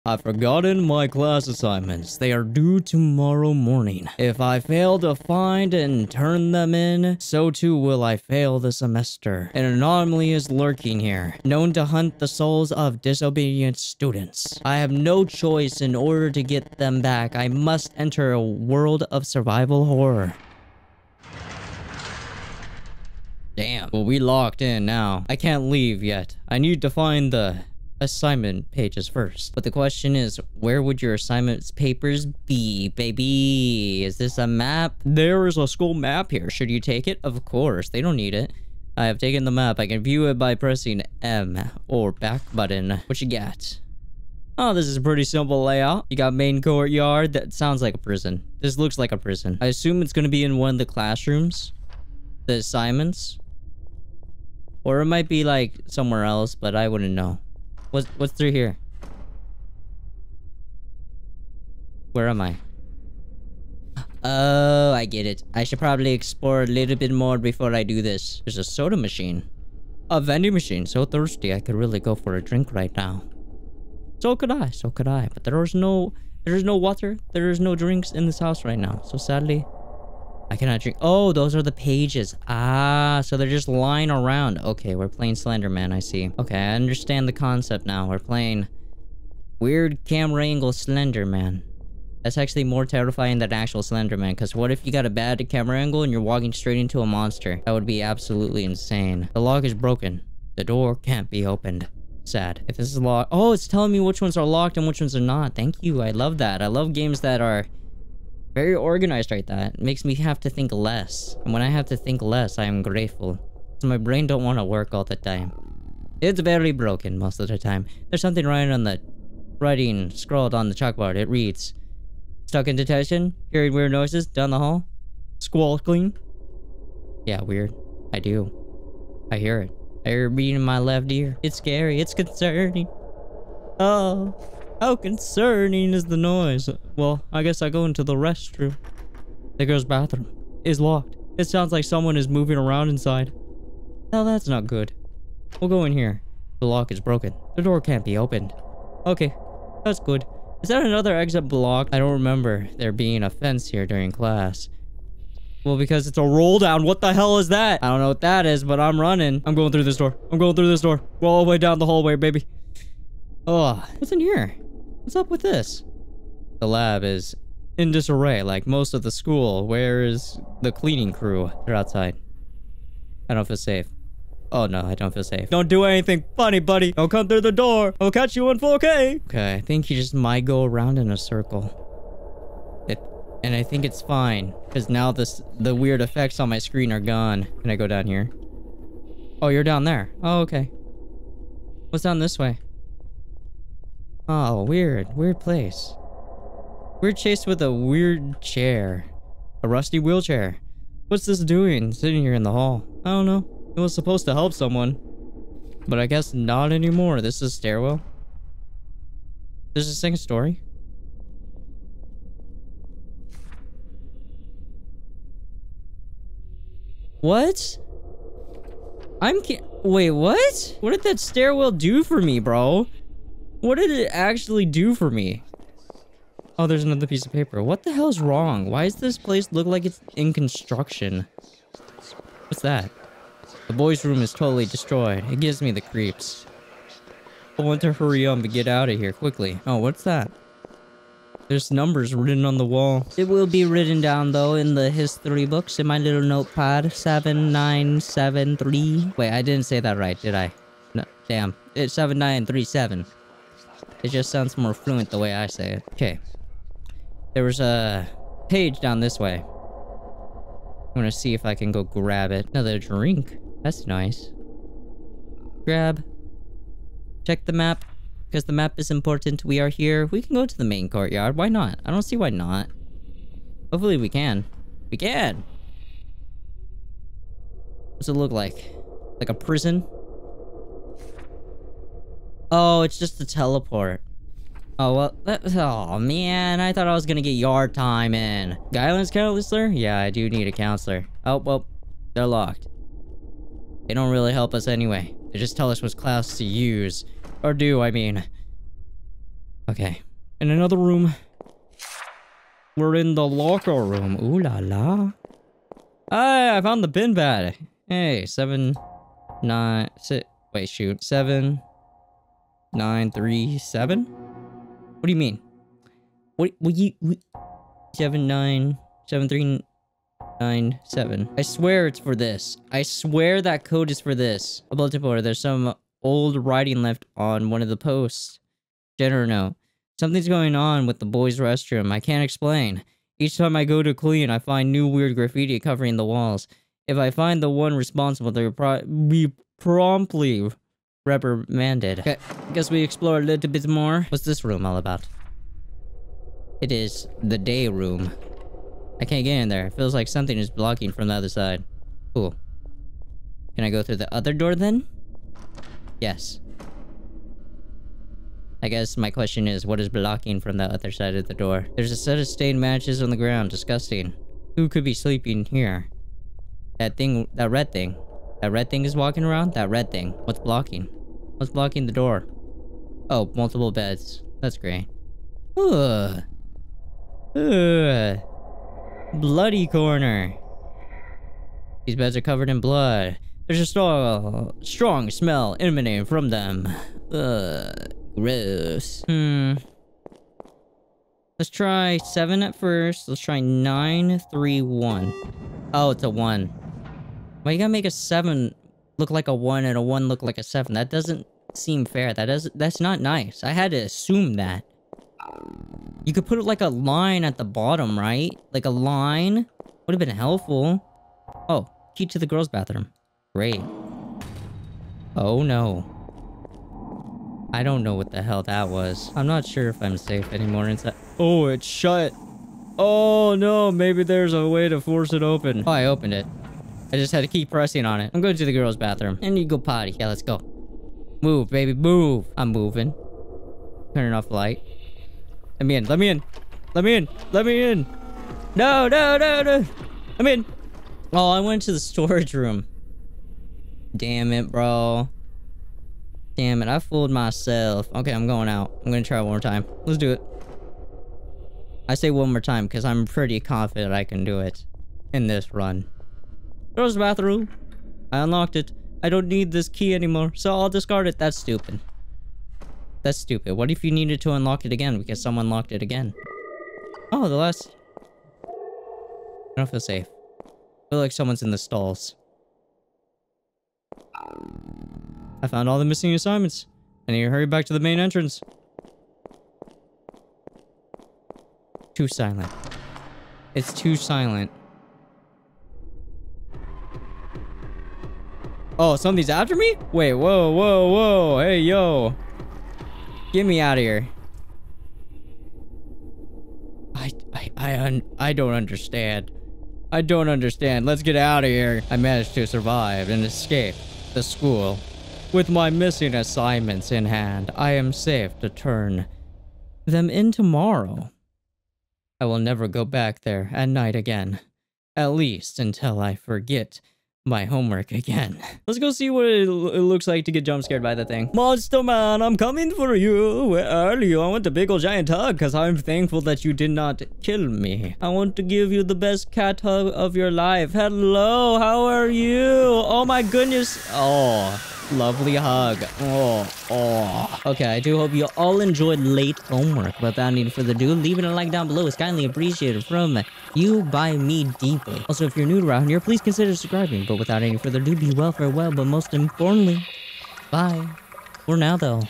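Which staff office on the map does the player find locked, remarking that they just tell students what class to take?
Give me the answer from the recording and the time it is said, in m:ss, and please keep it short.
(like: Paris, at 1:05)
Guidance counselor, at 4:48.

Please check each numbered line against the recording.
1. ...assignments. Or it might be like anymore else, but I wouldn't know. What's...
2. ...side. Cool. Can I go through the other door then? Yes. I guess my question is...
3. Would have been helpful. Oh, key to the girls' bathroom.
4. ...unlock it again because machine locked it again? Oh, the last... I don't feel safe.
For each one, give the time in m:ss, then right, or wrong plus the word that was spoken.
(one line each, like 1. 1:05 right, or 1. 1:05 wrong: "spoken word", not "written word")
1. 0:52 wrong: "somewhere", not "anymore"
2. 5:51 right
3. 6:49 right
4. 7:44 wrong: "someone", not "machine".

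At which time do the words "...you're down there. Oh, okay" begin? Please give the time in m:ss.
3:09.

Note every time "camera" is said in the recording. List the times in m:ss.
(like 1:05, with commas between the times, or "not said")
1:30, 1:35.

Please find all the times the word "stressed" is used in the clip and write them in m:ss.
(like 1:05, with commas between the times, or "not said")
not said.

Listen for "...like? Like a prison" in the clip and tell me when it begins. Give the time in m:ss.
4:38.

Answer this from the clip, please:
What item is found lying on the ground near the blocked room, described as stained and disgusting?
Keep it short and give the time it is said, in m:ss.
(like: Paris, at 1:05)
Matches, at 6:02.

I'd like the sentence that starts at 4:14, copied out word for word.
It just sounds more fluent the way I say it.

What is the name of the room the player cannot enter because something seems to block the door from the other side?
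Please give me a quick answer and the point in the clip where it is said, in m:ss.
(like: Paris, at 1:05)
The day room, at 5:47.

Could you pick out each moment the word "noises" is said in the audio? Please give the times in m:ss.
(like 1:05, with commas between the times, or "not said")
2:03, 2:16.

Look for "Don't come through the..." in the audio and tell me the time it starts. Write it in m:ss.
2:56.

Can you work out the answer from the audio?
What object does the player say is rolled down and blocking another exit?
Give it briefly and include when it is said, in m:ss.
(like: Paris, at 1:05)
A fence, at 2:33.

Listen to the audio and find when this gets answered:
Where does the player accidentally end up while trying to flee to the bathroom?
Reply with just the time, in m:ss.
7:21.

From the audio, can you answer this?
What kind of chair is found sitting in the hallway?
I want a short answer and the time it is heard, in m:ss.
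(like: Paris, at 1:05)
A rusty wheelchair, at 3:19.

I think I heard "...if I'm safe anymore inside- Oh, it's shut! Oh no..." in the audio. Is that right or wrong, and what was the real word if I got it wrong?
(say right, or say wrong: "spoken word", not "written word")
right.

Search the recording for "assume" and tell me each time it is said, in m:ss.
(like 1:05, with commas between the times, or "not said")
0:49, 6:43.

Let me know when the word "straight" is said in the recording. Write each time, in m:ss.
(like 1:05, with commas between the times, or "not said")
1:36.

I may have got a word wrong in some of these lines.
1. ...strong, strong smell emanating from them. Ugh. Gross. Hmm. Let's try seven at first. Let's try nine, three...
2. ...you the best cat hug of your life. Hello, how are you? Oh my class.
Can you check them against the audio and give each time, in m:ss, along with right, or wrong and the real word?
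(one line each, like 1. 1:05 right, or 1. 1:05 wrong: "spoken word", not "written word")
1. 6:23 right
2. 8:48 wrong: "goodness", not "class".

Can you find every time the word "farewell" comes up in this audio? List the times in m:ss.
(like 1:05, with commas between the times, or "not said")
9:08.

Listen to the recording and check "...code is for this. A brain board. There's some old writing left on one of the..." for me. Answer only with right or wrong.
wrong.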